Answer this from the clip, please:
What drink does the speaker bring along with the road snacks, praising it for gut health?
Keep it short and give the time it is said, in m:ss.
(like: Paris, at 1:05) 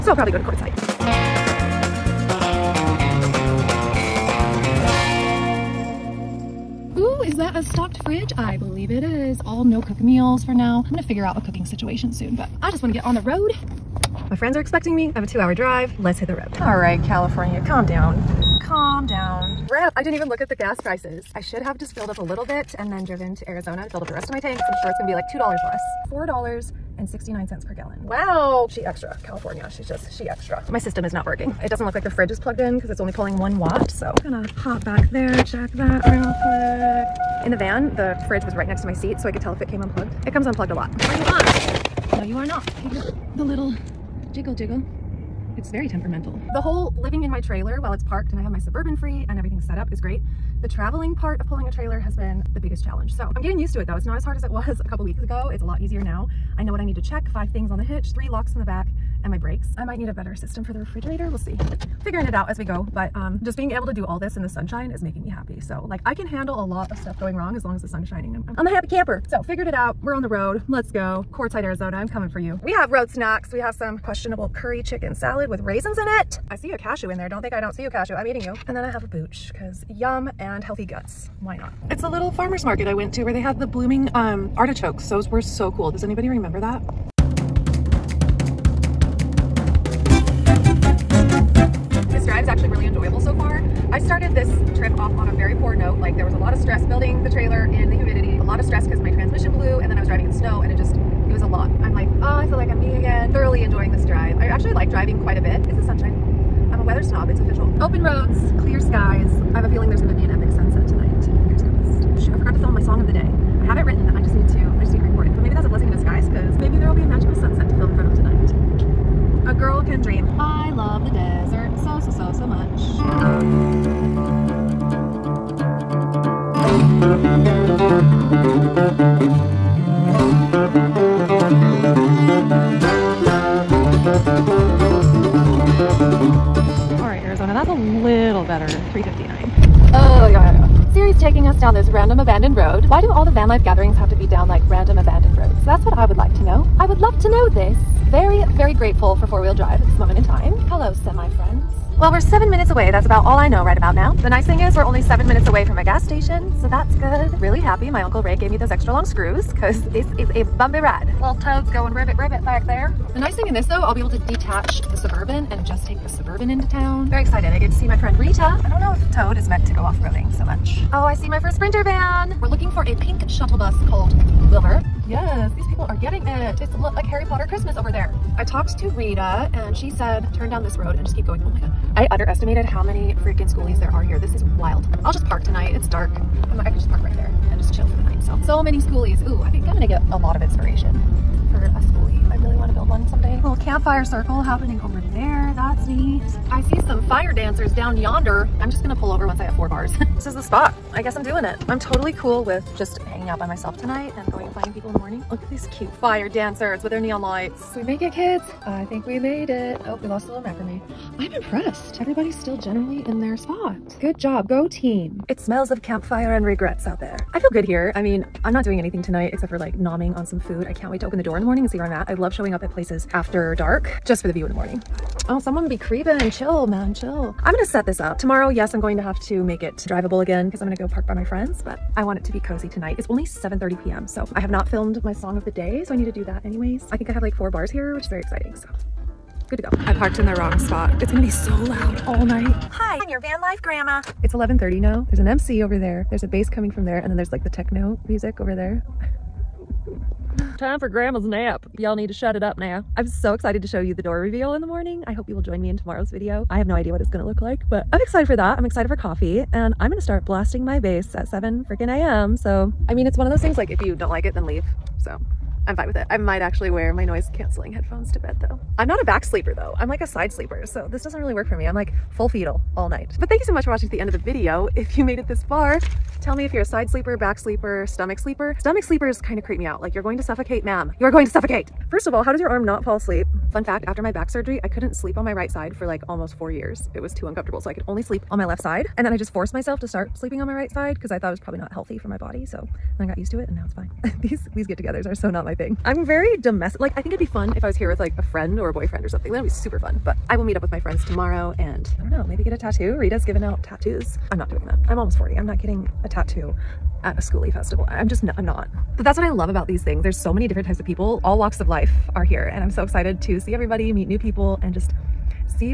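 booch, at 1:19.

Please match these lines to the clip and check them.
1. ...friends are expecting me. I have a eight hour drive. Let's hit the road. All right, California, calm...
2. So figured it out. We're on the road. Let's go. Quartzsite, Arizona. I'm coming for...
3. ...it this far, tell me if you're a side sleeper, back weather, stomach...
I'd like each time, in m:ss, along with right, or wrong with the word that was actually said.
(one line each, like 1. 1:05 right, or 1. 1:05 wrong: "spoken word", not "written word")
1. 0:14 wrong: "two", not "eight"
2. 1:09 right
3. 4:35 wrong: "sleeper", not "weather".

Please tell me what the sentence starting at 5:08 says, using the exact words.
But that's what I love about these things.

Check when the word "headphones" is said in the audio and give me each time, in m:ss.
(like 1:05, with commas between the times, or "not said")
4:27.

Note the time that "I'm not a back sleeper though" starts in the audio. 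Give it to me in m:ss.
4:28.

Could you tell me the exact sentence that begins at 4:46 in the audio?
It was too uncomfortable, so I could only sleep on my left side.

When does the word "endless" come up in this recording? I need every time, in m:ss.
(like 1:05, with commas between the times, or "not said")
not said.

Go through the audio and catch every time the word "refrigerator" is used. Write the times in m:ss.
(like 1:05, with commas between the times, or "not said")
1:00.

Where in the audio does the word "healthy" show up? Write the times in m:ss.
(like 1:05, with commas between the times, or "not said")
1:20, 4:51.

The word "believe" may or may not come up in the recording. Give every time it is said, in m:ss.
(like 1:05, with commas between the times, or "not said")
0:08.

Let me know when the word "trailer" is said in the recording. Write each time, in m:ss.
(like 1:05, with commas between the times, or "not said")
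0:47, 0:51.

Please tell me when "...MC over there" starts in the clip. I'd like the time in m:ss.
4:05.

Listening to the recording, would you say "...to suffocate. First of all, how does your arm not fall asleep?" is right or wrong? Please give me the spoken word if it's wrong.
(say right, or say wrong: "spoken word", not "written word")
right.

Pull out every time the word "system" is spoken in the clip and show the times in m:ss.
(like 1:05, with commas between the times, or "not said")
0:30, 1:00.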